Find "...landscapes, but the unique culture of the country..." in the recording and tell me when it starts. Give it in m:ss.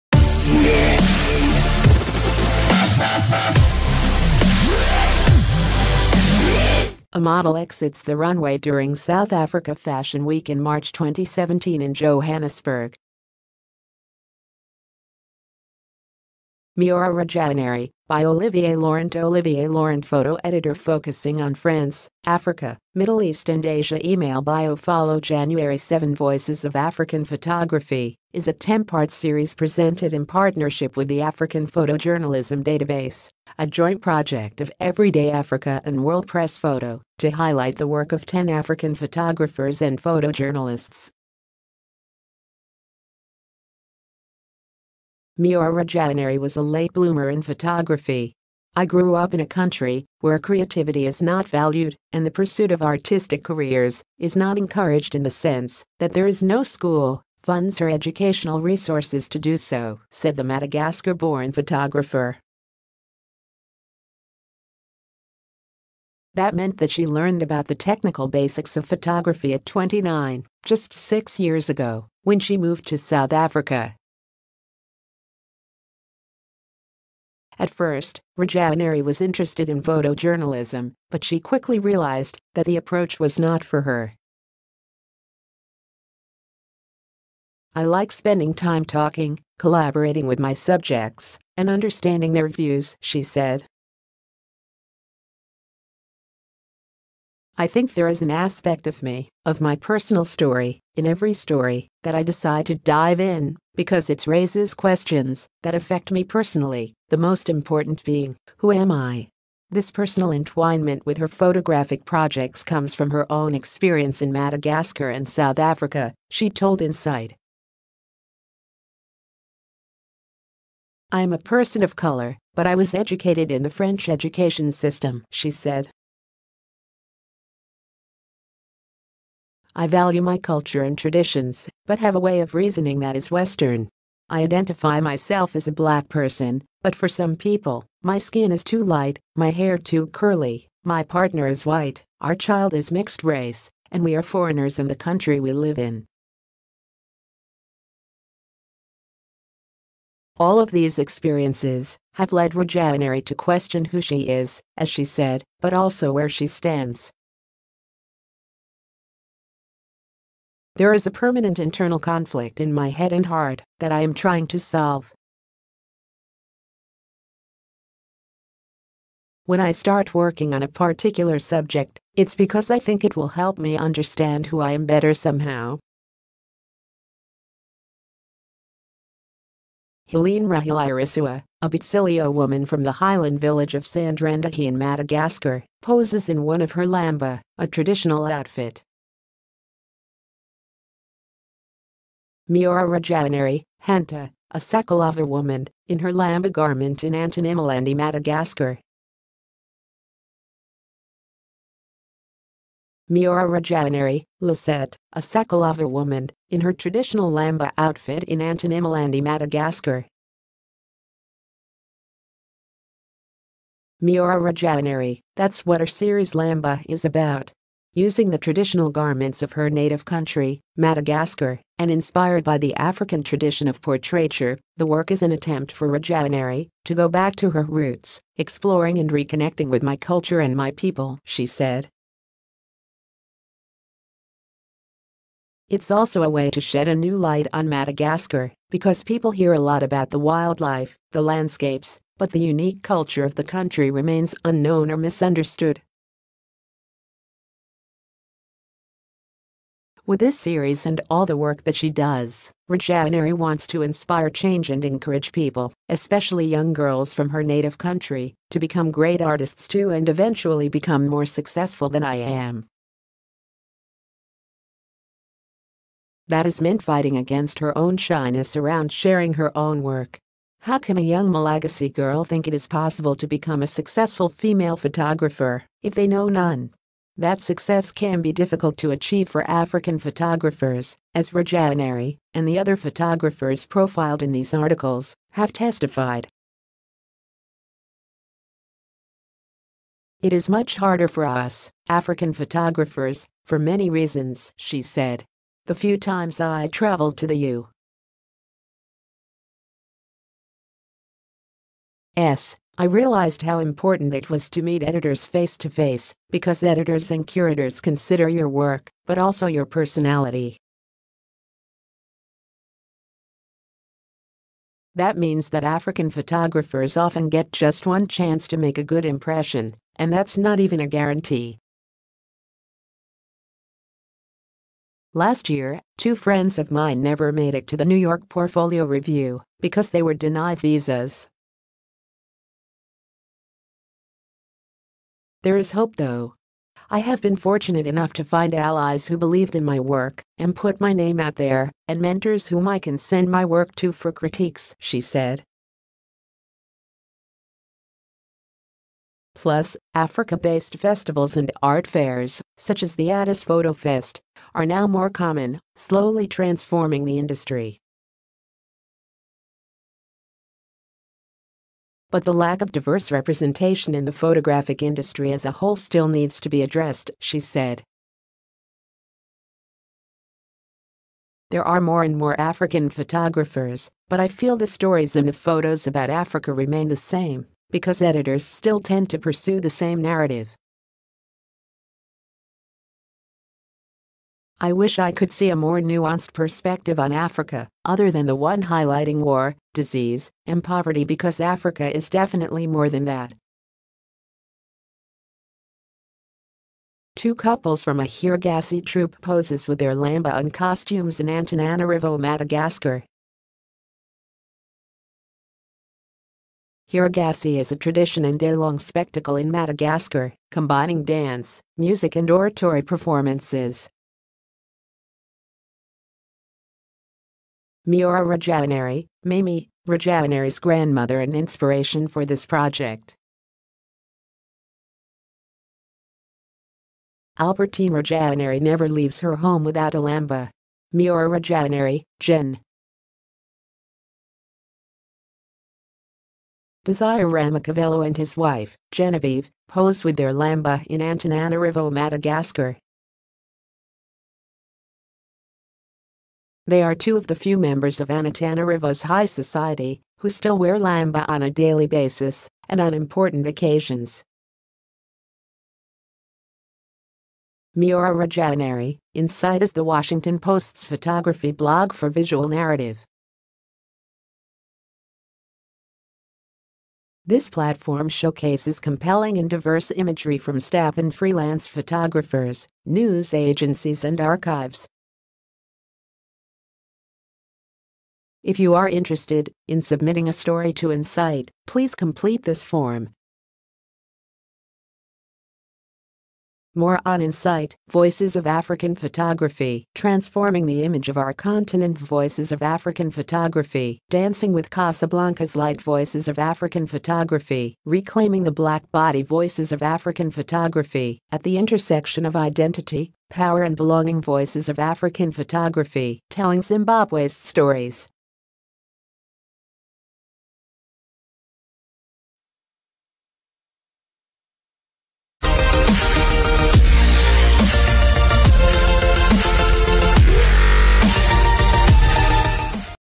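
4:01.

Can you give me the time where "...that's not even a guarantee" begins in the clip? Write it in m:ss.
5:20.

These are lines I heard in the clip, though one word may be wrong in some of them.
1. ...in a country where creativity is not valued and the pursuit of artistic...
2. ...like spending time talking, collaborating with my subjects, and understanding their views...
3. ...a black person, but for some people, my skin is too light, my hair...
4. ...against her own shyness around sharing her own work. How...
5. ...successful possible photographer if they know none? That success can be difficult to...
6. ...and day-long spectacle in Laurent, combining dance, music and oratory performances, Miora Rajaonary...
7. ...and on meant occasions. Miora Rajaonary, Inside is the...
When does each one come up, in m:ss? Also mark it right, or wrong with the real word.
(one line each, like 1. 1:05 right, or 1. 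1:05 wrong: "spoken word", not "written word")
1. 0:49 right
2. 1:27 right
3. 2:15 right
4. 4:27 right
5. 4:33 wrong: "female", not "possible"
6. 6:48 wrong: "Madagascar", not "Laurent"
7. 7:32 wrong: "important", not "meant".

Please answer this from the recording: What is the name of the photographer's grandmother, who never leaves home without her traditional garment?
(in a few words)
Albertine Rajanari.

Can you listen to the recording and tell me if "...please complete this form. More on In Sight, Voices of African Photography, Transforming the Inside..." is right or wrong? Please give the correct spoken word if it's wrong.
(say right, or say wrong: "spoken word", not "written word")
wrong: "Image", not "Inside".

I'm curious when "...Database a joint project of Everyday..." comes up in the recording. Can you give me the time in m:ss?
0:32.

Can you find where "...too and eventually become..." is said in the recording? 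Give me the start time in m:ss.
4:19.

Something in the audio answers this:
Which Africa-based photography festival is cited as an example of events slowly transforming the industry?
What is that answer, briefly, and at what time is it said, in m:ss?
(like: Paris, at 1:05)
Addis Photo Fest, at 5:53.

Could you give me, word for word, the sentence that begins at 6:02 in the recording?
but the lack of diverse representation in the photographic industry as a whole still needs to be addressed, she said.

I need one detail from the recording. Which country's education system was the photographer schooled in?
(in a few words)
French.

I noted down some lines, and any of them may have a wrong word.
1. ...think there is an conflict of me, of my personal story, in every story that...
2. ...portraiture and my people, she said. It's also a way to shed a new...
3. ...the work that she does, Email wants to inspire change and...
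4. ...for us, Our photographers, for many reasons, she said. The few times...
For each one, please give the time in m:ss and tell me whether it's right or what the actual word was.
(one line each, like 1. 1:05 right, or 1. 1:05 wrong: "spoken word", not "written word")
1. 1:37 wrong: "aspect", not "conflict"
2. 3:49 wrong: "culture", not "portraiture"
3. 4:11 wrong: "Rajaonary", not "Email"
4. 4:51 wrong: "African", not "Our".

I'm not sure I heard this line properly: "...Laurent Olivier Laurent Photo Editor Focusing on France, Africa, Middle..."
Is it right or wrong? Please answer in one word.
right.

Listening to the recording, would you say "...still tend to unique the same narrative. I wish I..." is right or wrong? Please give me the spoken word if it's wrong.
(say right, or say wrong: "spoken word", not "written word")
wrong: "pursue", not "unique".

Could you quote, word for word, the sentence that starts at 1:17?
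At first, Rajaonary was interested in photojournalism, but she quickly realized that the approach was not for her.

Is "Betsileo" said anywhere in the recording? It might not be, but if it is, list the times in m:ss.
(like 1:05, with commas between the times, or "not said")
3:01.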